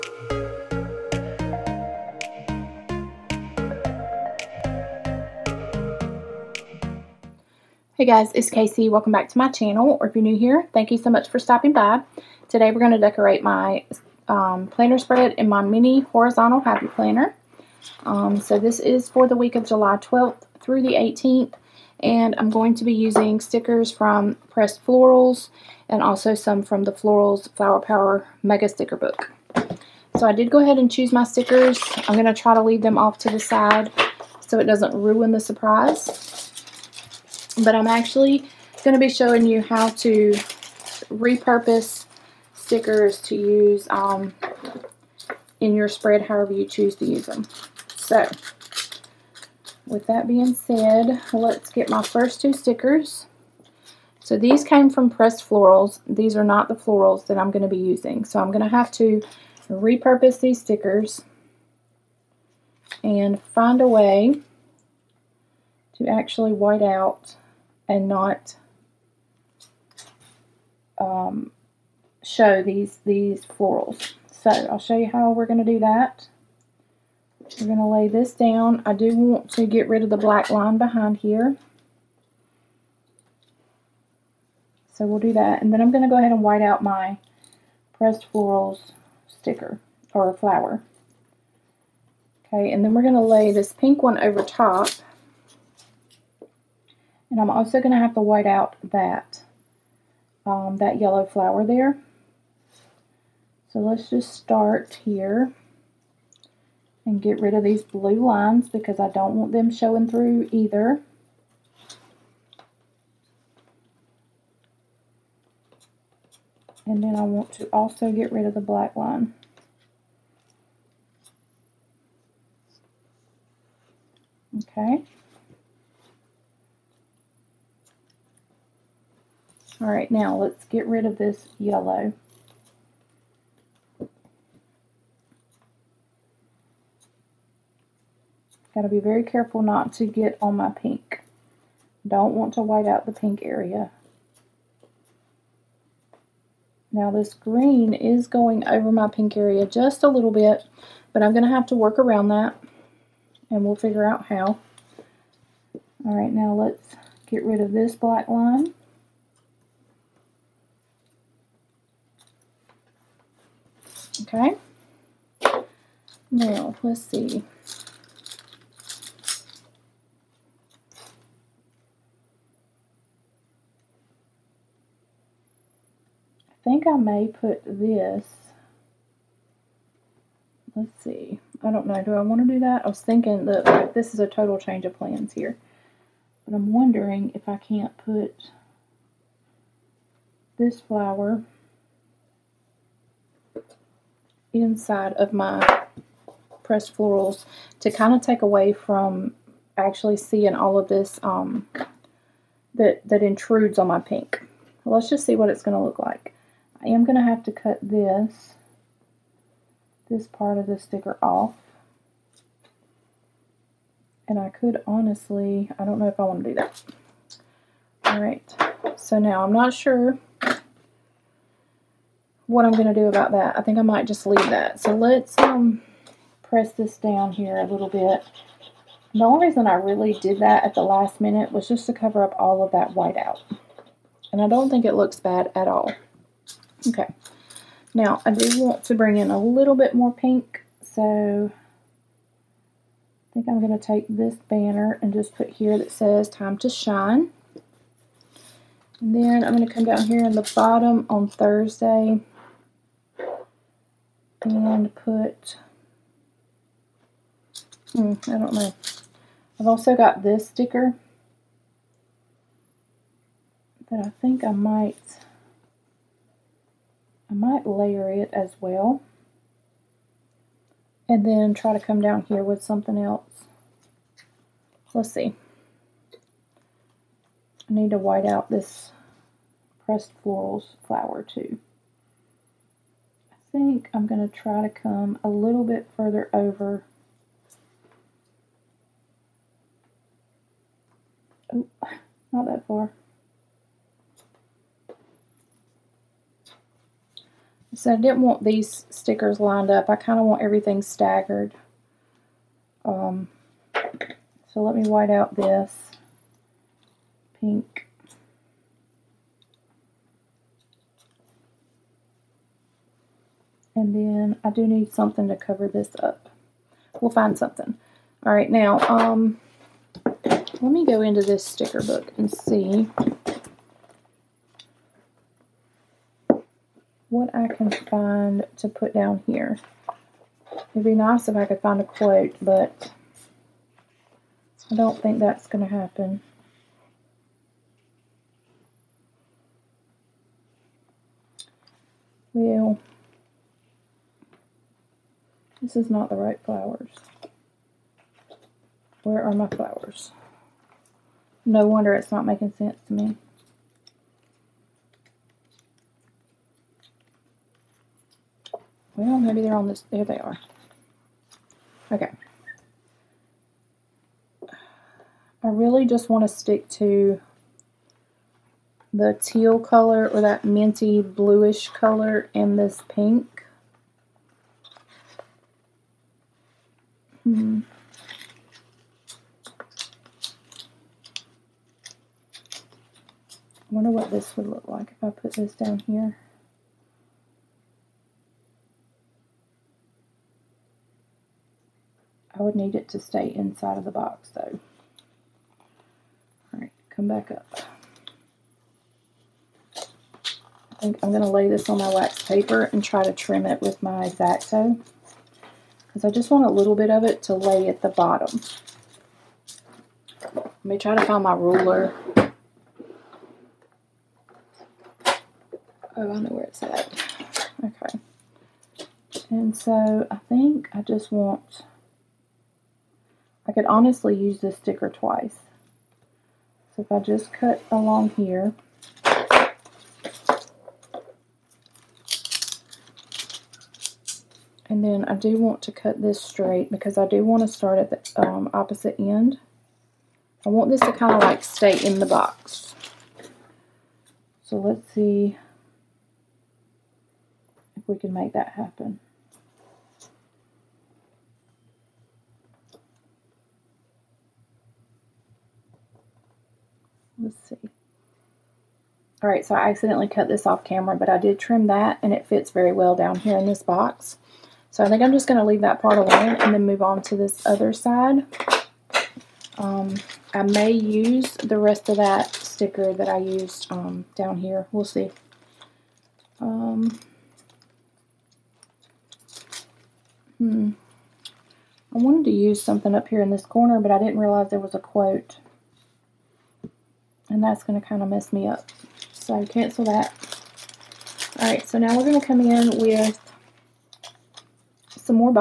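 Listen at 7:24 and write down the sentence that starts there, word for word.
So let's see if we can make that happen.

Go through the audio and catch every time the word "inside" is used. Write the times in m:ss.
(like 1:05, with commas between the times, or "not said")
3:14, 6:33.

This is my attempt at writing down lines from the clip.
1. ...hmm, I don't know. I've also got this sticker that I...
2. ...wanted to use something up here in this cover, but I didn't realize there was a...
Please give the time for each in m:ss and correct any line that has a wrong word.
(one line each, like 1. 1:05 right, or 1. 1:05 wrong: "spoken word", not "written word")
1. 4:17 right
2. 8:01 wrong: "corner", not "cover".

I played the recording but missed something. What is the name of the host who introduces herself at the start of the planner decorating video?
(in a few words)
Casey.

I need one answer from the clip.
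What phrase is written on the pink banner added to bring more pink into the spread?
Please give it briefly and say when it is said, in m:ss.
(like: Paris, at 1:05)
time to shine, at 4:06.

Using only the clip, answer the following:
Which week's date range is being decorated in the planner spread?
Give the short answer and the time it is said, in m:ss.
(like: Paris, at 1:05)
July 12th through the 18th, at 0:19.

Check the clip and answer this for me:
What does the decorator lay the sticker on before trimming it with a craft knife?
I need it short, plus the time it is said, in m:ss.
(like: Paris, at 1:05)
wax paper, at 6:41.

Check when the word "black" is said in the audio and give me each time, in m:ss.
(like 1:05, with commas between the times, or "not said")
1:20, 1:58, 2:37.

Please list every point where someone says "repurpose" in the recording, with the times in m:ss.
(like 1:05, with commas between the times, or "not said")
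0:41, 0:59.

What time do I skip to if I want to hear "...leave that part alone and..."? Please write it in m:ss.
7:45.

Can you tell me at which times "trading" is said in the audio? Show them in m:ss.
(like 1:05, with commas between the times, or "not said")
not said.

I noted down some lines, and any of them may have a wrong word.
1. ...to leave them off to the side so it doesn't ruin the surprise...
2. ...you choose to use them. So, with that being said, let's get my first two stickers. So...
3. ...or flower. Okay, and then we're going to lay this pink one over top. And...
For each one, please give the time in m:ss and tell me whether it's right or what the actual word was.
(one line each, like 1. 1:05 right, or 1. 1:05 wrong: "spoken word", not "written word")
1. 0:32 right
2. 0:46 right
3. 1:30 right.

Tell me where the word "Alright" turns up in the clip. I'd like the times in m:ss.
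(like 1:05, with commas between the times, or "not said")
3:38, 6:36, 8:11.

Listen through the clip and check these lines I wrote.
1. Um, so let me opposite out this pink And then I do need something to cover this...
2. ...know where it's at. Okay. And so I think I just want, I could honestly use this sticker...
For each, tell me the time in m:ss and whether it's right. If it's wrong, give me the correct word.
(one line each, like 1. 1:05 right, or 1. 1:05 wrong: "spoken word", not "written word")
1. 5:02 wrong: "white", not "opposite"
2. 6:56 right.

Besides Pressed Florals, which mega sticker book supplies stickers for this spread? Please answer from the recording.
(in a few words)
Florals Flower Power.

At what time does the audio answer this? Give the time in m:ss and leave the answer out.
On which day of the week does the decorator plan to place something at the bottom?
4:11.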